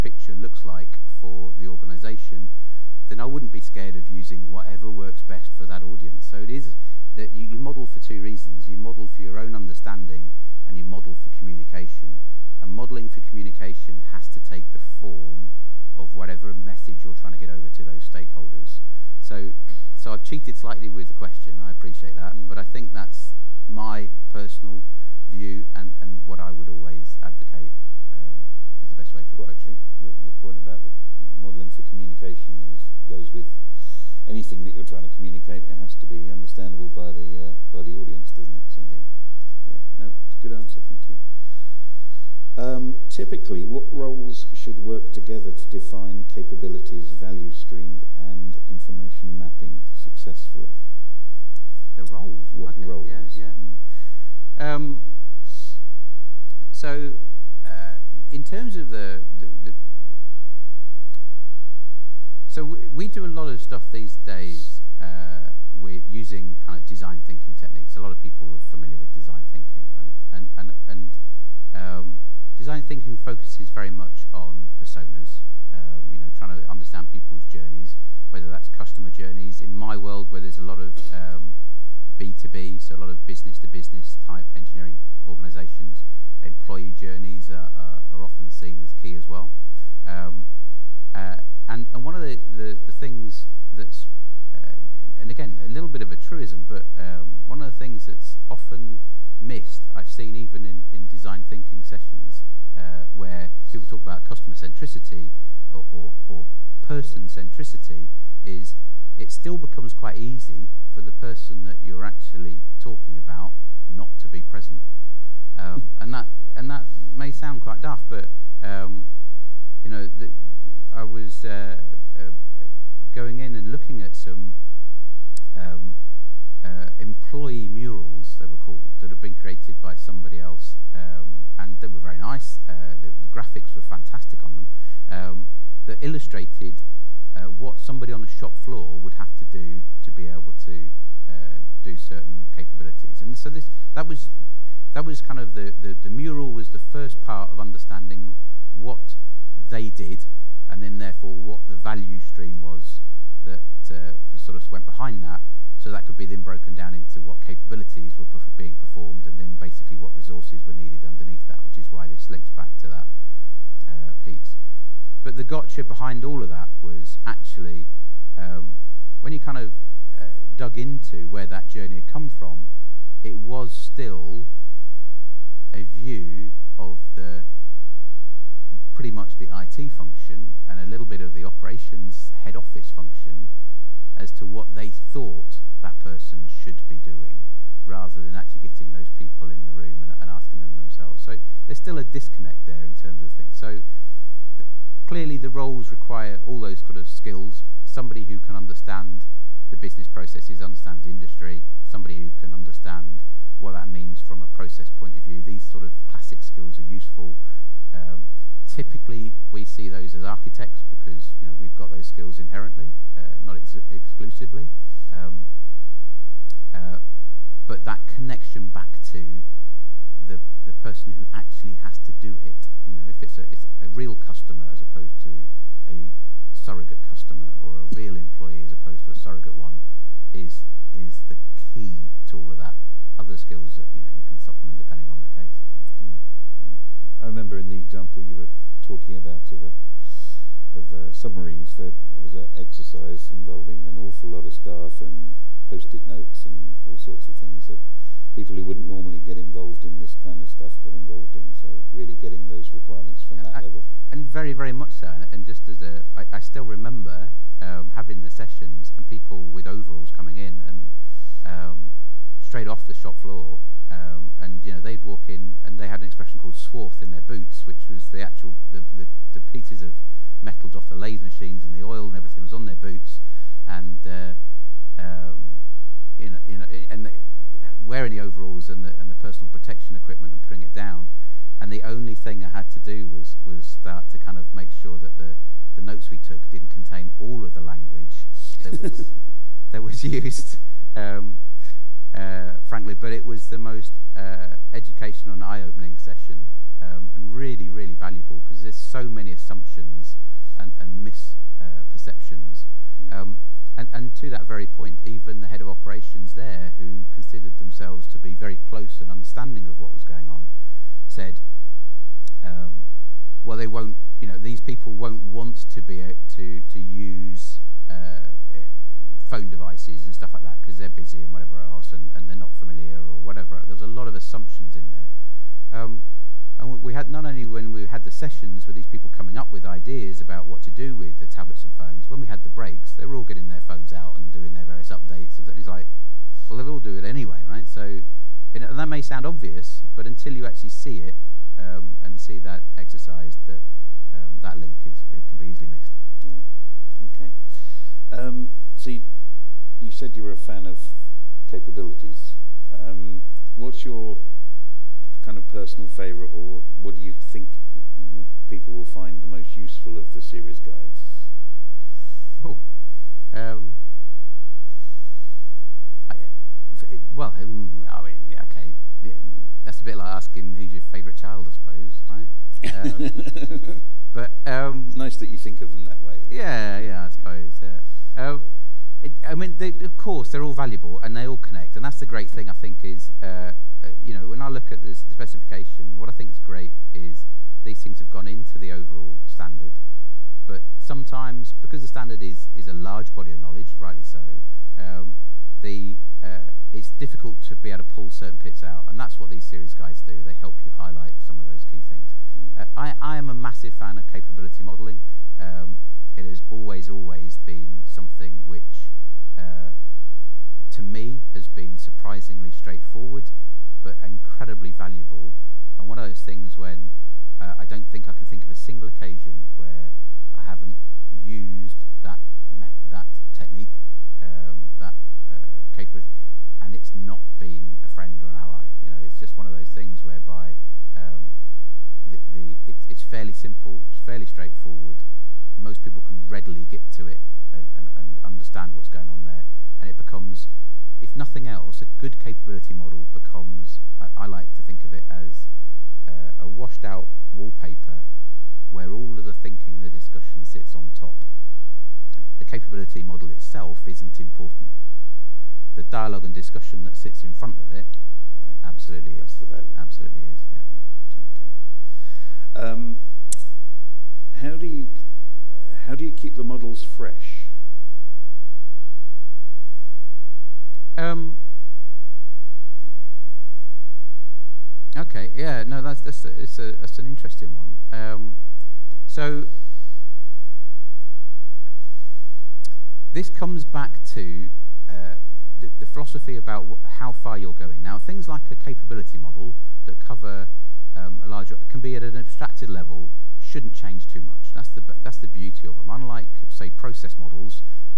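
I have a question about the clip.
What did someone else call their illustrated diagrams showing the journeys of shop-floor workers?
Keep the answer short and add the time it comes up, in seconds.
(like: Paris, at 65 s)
Employee murals, at 126 s.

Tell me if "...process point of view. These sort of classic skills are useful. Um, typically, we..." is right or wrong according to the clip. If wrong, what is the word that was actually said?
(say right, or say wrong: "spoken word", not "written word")
right.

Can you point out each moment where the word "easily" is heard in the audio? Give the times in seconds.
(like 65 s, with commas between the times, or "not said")
345 s.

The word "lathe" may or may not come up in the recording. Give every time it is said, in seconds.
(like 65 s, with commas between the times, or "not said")
270 s.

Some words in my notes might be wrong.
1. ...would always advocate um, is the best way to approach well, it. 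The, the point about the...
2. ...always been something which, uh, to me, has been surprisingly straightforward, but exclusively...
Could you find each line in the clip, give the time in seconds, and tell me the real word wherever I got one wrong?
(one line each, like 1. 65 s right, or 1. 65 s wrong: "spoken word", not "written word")
1. 26 s right
2. 406 s wrong: "incredibly", not "exclusively".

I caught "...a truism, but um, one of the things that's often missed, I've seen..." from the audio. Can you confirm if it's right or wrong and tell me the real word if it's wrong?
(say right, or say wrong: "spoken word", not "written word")
right.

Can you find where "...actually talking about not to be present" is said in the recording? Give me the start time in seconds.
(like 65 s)
112 s.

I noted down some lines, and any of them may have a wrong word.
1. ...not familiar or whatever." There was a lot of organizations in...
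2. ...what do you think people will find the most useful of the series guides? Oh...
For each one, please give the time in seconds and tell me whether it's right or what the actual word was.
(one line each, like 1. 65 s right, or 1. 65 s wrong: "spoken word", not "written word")
1. 322 s wrong: "assumptions", not "organizations"
2. 356 s right.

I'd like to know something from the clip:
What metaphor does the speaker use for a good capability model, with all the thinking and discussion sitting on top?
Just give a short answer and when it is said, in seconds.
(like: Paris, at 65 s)
Washed-out wallpaper, at 446 s.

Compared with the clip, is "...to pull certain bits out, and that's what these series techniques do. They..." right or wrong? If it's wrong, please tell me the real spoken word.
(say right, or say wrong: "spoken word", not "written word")
wrong: "guides", not "techniques".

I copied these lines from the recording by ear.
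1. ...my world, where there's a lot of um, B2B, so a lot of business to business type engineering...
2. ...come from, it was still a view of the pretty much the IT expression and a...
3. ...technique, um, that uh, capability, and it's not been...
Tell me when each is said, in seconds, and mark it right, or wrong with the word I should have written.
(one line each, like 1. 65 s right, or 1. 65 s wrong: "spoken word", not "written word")
1. 79 s right
2. 172 s wrong: "function", not "expression"
3. 423 s right.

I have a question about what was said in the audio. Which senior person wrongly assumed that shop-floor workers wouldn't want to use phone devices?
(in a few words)
Head of operations.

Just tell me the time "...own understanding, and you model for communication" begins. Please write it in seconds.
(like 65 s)
9 s.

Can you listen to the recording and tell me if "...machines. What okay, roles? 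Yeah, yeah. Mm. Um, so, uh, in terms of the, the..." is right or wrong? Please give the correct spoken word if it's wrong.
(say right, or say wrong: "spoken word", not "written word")
wrong: "roles", not "machines".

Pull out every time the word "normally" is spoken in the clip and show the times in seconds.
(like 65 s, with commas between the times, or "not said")
248 s.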